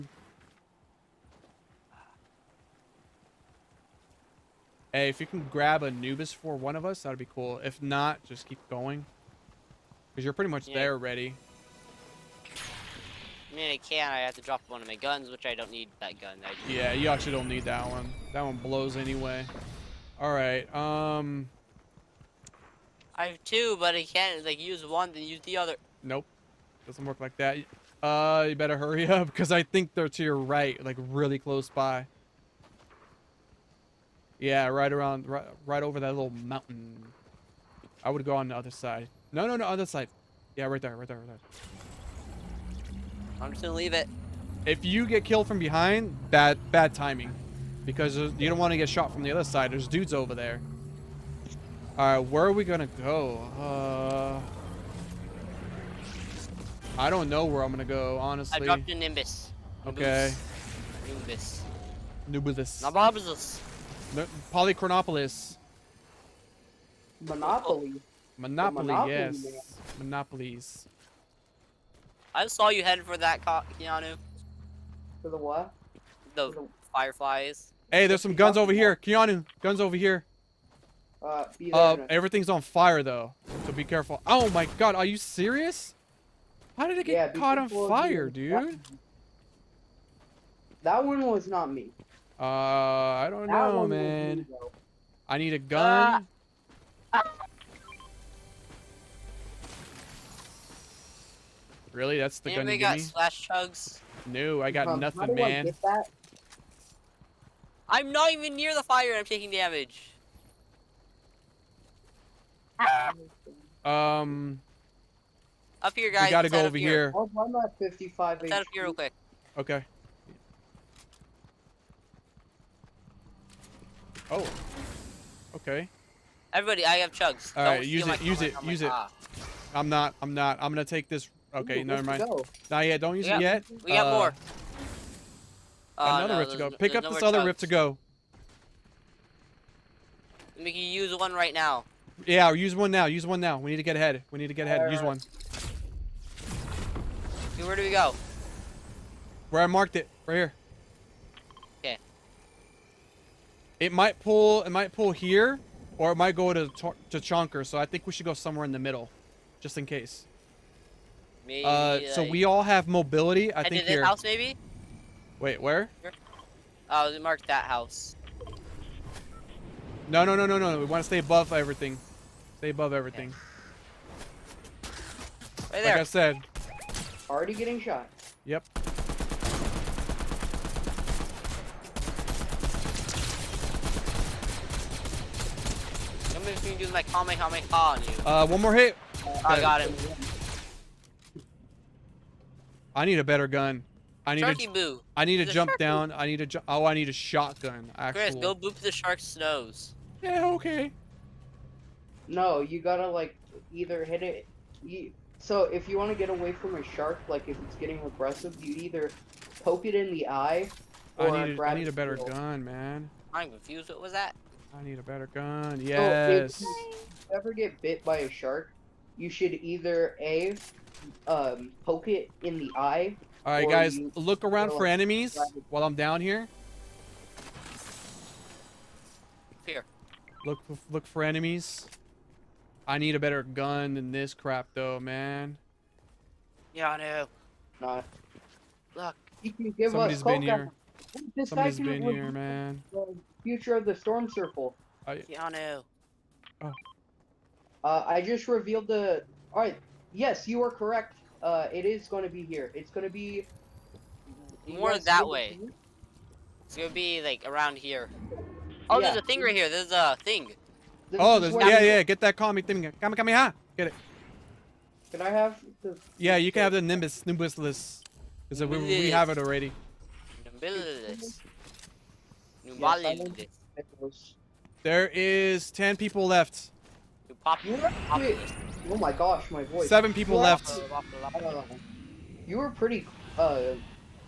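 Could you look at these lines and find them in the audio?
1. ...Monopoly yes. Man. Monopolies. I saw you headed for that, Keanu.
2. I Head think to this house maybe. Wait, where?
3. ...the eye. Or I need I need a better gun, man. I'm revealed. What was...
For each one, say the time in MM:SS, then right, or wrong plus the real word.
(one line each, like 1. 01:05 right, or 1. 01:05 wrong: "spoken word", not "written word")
1. 01:08 right
2. 02:43 right
3. 03:30 wrong: "confused", not "revealed".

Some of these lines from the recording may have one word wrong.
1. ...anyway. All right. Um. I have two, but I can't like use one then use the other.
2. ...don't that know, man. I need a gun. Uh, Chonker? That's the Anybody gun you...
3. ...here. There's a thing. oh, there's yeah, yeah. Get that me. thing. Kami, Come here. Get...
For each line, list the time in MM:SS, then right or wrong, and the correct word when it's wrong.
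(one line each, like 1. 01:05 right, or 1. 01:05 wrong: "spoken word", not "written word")
1. 00:18 right
2. 01:33 wrong: "Really", not "Chonker"
3. 04:19 right.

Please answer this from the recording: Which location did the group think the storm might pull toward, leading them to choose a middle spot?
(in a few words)
Chonker.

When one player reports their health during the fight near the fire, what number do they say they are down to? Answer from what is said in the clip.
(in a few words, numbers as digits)
55.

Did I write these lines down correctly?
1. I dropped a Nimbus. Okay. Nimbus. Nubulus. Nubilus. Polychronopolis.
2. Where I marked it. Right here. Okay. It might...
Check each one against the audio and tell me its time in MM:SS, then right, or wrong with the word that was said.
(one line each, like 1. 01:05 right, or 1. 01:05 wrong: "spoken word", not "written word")
1. 00:58 right
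2. 02:29 right.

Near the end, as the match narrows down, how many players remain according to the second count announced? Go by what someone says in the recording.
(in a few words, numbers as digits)
7.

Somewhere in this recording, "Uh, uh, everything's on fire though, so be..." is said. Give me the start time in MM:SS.
01:21.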